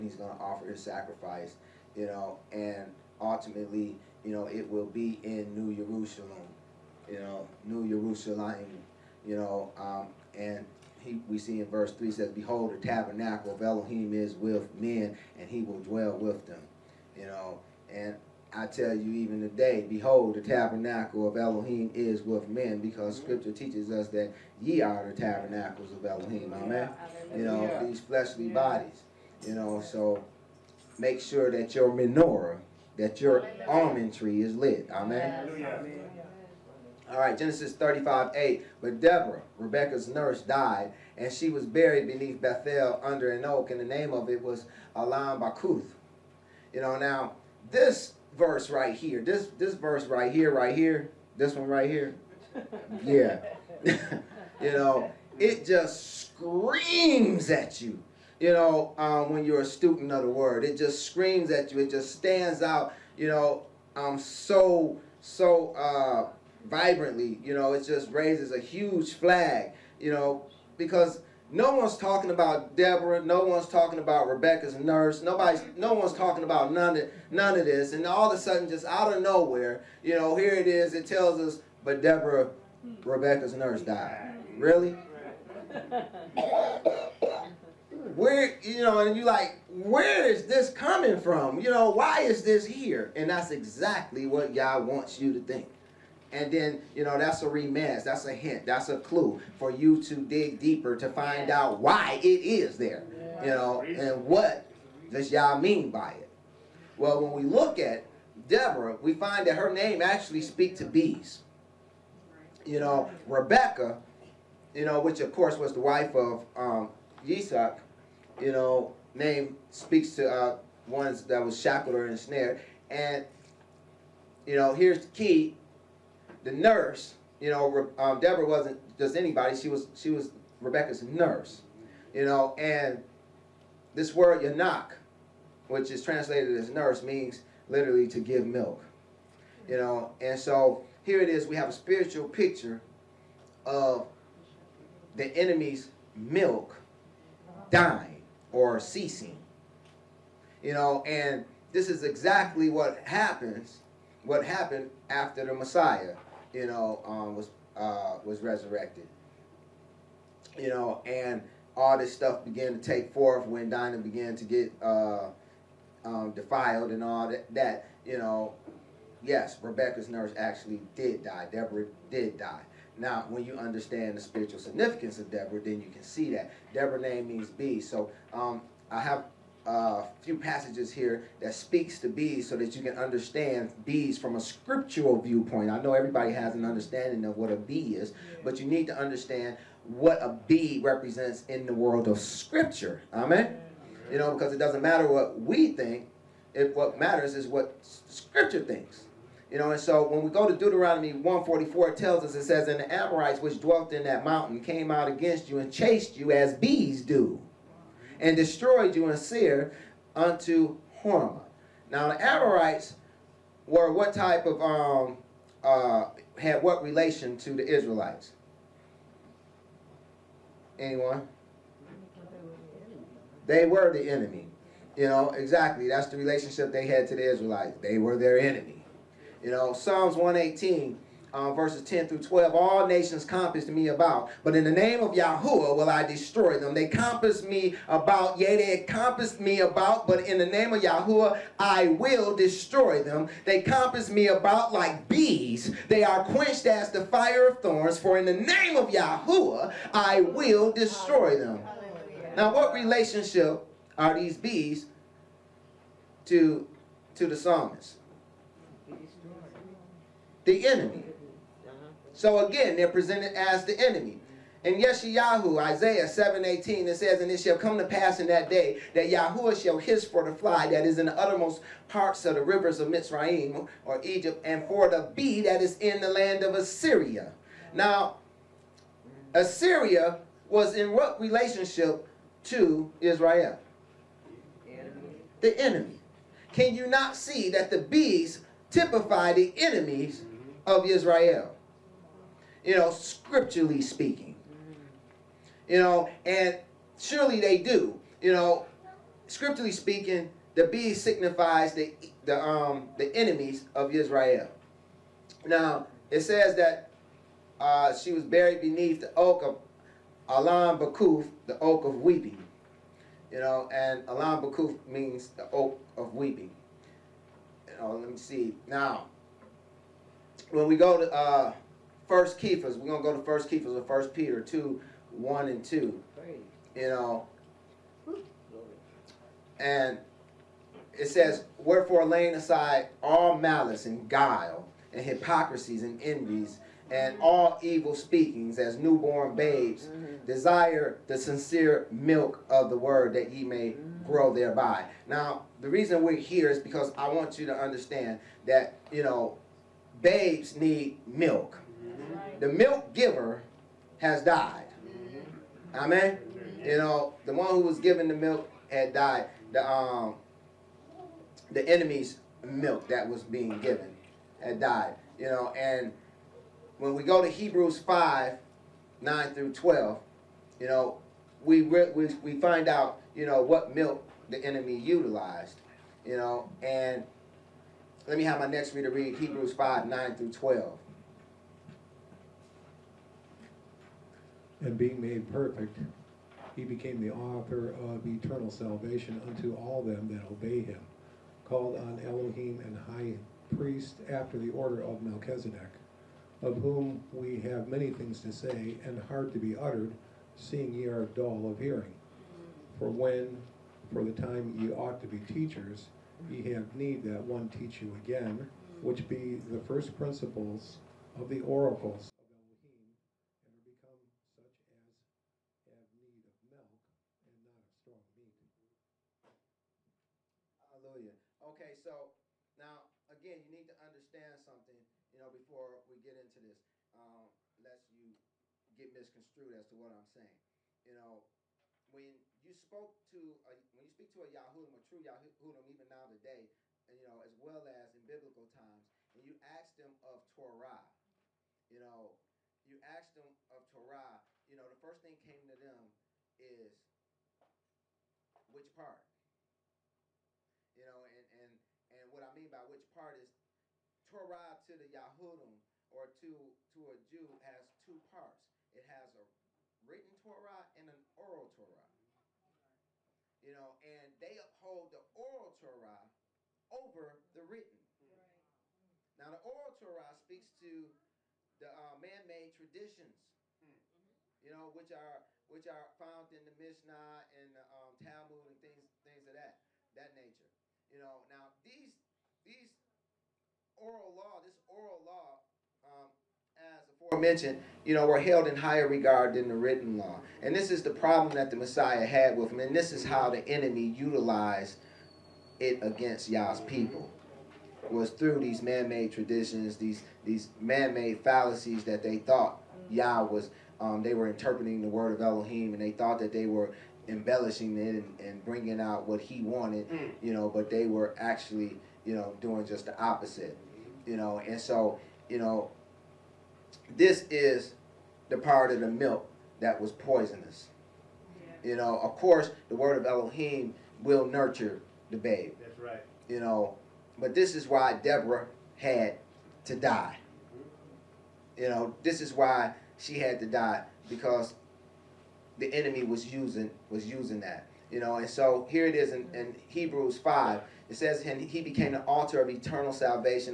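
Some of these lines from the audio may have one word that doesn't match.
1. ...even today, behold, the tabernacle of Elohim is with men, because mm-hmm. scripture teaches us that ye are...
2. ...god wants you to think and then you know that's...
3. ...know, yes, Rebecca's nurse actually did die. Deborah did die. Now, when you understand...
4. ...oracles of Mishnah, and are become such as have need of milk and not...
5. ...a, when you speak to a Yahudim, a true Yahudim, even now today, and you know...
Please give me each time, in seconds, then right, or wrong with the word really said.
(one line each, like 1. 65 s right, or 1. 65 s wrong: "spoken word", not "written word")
1. 19 s right
2. 94 s right
3. 168 s right
4. 411 s wrong: "Elohim", not "Mishnah"
5. 433 s right.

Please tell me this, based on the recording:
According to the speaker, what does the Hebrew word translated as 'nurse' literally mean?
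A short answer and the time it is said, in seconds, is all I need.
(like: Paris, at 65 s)
to give milk, at 138 s.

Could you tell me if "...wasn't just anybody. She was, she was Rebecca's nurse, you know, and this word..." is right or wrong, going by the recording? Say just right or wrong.
right.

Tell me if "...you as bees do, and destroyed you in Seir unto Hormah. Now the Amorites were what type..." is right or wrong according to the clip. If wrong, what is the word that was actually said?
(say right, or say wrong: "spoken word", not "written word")
right.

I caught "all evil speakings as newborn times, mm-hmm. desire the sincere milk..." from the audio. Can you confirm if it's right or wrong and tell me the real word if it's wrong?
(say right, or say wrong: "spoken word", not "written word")
wrong: "babes", not "times".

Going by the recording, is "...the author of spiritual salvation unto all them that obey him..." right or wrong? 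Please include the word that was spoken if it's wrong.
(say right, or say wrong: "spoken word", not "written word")
wrong: "eternal", not "spiritual".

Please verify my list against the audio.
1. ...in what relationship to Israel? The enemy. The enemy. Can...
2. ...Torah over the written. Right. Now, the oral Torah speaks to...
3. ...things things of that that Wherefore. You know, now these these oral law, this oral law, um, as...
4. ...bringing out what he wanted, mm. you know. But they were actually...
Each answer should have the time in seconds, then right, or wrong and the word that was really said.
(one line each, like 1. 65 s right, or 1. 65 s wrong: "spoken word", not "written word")
1. 280 s right
2. 465 s right
3. 478 s wrong: "nature", not "Wherefore"
4. 508 s right.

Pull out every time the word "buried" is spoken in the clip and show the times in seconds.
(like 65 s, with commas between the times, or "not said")
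41 s, 308 s.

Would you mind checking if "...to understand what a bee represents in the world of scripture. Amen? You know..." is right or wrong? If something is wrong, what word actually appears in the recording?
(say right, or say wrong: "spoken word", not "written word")
right.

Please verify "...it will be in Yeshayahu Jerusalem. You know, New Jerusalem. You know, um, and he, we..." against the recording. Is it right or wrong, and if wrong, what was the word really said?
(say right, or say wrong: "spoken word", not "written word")
wrong: "New", not "Yeshayahu".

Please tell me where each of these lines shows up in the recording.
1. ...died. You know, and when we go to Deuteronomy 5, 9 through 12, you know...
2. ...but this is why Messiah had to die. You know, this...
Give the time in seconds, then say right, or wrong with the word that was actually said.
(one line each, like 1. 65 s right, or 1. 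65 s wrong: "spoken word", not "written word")
1. 364 s wrong: "Hebrews", not "Deuteronomy"
2. 527 s wrong: "Deborah", not "Messiah".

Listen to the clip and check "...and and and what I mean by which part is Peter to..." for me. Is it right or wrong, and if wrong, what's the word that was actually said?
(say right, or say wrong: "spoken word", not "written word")
wrong: "Torah", not "Peter".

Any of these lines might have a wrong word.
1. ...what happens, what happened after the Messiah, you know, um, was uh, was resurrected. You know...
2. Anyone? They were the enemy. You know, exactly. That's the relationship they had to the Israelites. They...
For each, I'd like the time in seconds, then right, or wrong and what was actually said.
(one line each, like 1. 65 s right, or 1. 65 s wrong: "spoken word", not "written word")
1. 152 s right
2. 220 s right.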